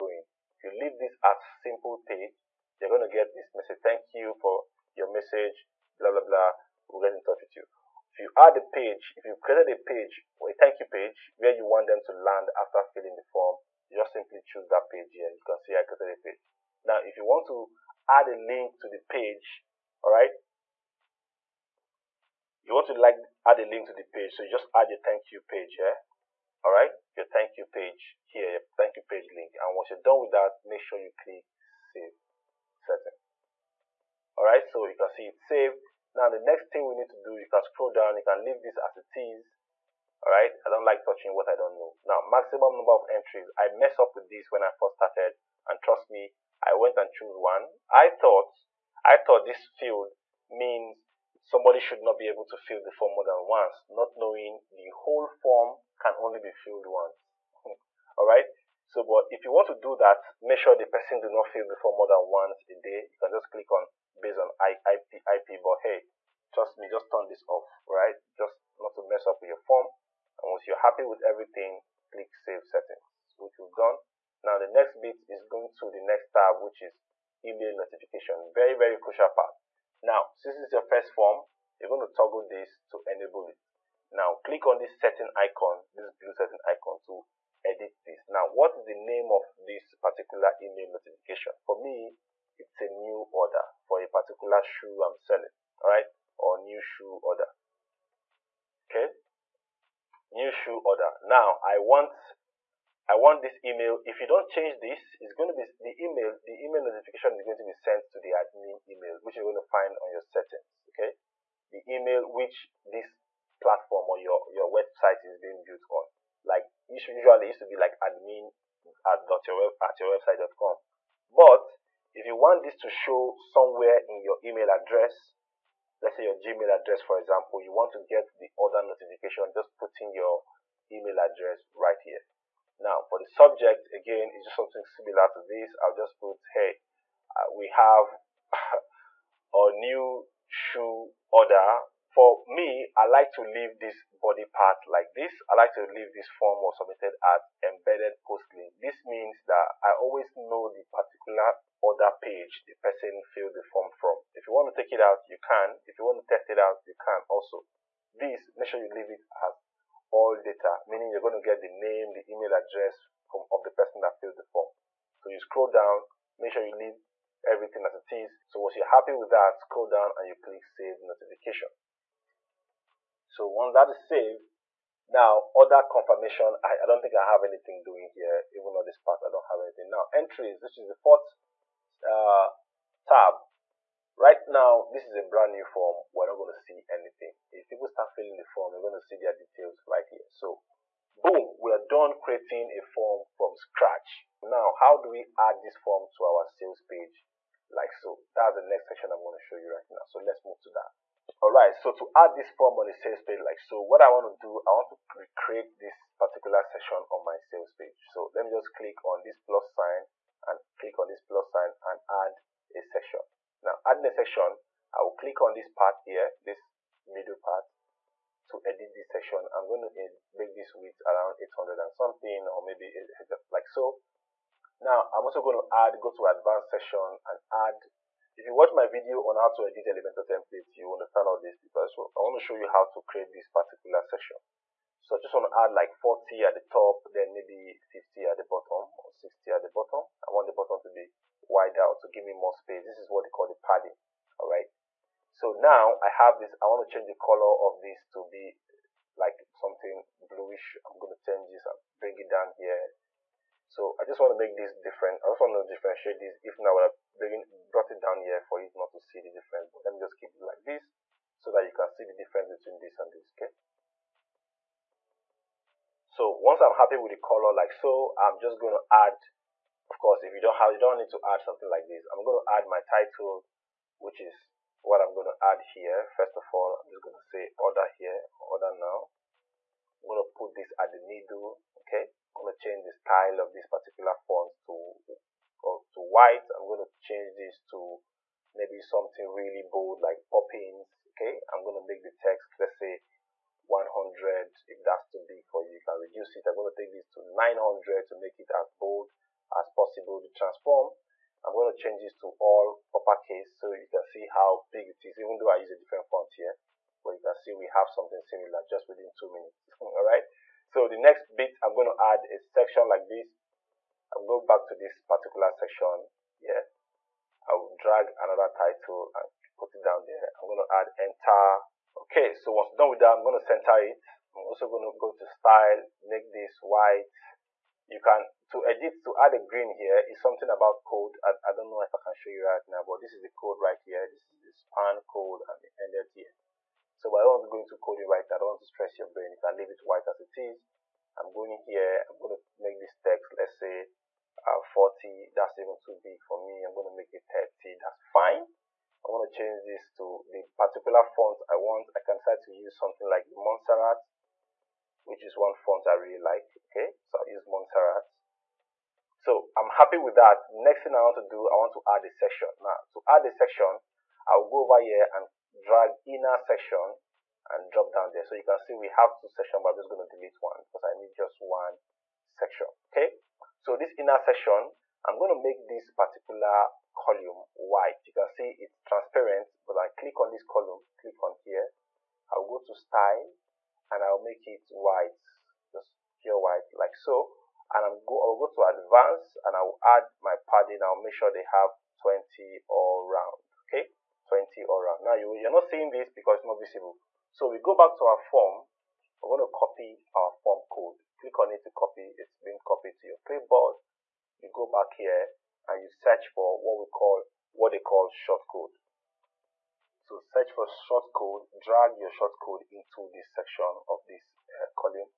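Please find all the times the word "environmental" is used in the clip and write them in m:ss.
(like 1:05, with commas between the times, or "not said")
not said.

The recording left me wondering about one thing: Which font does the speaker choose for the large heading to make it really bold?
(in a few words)
Poppins.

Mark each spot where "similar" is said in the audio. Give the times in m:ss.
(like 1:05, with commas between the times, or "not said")
2:14, 5:08.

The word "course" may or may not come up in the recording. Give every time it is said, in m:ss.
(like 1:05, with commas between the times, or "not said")
4:29.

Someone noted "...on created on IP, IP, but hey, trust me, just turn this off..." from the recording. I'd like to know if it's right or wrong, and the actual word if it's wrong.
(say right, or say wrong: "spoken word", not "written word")
wrong: "based", not "created".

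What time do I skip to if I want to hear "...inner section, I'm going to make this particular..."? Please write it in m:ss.
6:13.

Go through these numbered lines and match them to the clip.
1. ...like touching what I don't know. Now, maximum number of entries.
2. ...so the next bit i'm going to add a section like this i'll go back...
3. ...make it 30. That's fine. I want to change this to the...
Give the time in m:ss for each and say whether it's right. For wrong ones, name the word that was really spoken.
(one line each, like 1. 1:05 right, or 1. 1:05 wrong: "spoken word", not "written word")
1. 0:40 right
2. 5:10 right
3. 5:46 right.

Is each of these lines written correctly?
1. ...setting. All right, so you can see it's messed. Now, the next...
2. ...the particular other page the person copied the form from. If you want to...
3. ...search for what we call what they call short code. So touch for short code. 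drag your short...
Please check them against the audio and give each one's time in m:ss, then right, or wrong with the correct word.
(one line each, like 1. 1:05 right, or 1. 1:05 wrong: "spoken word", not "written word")
1. 0:32 wrong: "saved", not "messed"
2. 2:30 wrong: "filled", not "copied"
3. 6:45 wrong: "search", not "touch".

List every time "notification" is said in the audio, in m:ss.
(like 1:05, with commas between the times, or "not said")
1:17, 1:30, 1:46, 2:08, 2:50.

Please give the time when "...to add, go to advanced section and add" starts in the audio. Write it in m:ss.
3:45.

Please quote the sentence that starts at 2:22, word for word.
For me, I like to leave this body part like this.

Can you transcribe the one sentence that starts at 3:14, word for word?
Now, how do we add this form to our sales page?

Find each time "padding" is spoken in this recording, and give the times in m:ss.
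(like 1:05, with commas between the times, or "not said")
4:03, 6:30.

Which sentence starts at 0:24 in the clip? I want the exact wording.
So you just add your thank you page here.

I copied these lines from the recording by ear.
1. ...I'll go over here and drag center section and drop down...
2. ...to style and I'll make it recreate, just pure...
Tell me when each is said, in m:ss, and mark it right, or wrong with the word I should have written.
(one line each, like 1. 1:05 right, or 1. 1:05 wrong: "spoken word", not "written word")
1. 6:04 wrong: "inner", not "center"
2. 6:22 wrong: "white", not "recreate".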